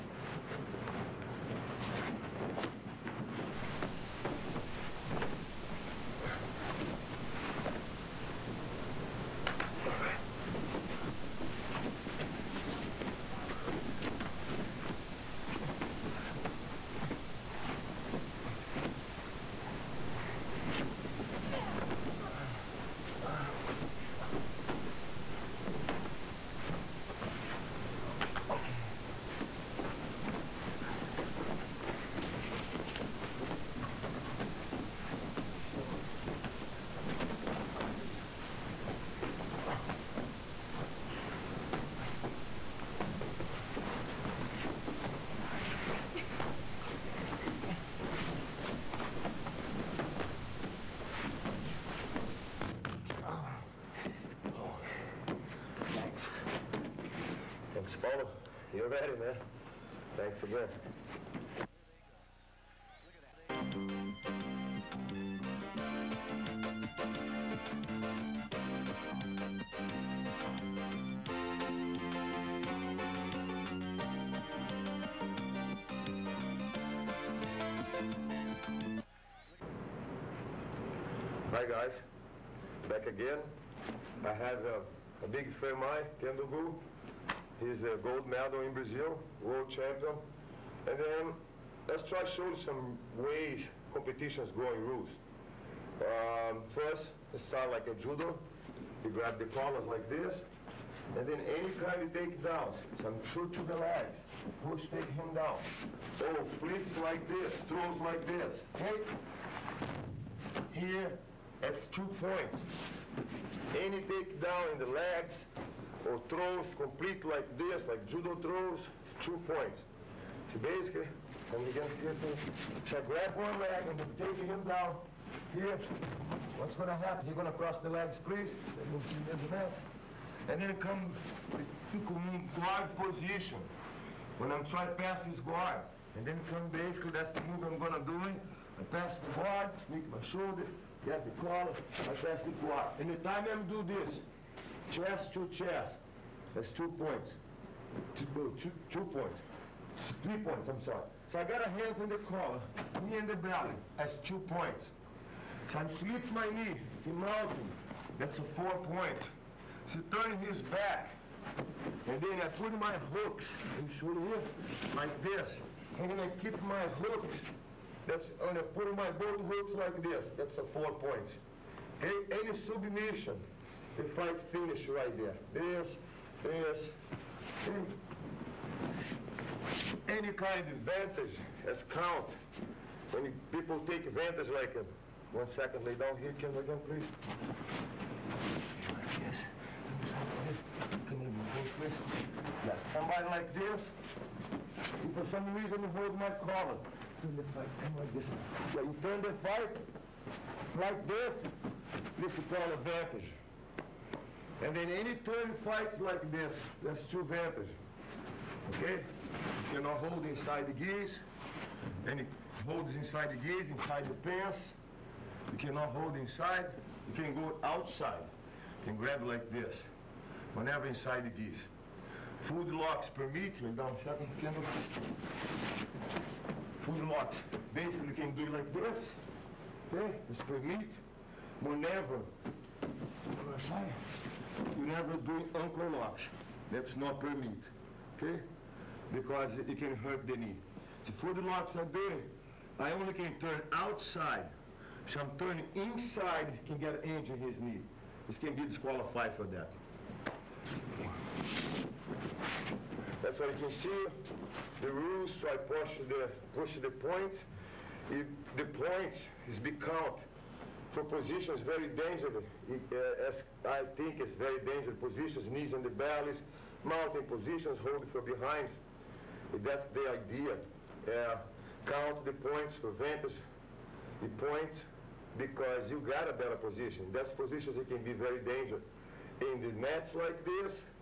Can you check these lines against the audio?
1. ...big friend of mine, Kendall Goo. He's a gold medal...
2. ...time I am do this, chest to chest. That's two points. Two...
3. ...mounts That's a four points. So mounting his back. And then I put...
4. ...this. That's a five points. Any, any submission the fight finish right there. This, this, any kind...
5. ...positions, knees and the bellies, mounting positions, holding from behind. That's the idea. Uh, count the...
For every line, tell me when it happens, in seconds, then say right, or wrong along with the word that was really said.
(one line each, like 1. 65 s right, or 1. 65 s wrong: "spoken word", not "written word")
1. 85 s right
2. 143 s right
3. 157 s wrong: "turning", not "mounting"
4. 170 s wrong: "four", not "five"
5. 264 s right.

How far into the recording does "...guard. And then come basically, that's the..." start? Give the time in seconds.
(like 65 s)
135 s.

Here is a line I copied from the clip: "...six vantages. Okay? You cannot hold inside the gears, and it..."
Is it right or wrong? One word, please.
wrong.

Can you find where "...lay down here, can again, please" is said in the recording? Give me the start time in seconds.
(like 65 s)
185 s.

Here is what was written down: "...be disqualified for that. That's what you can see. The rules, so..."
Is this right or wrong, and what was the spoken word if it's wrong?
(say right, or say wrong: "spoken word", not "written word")
right.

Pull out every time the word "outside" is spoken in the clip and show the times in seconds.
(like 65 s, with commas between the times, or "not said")
217 s, 233 s, 243 s.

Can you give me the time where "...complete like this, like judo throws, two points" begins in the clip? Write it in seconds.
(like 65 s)
116 s.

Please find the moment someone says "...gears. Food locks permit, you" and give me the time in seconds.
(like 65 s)
221 s.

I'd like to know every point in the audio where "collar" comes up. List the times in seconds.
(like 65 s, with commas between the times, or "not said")
99 s, 141 s, 152 s, 196 s.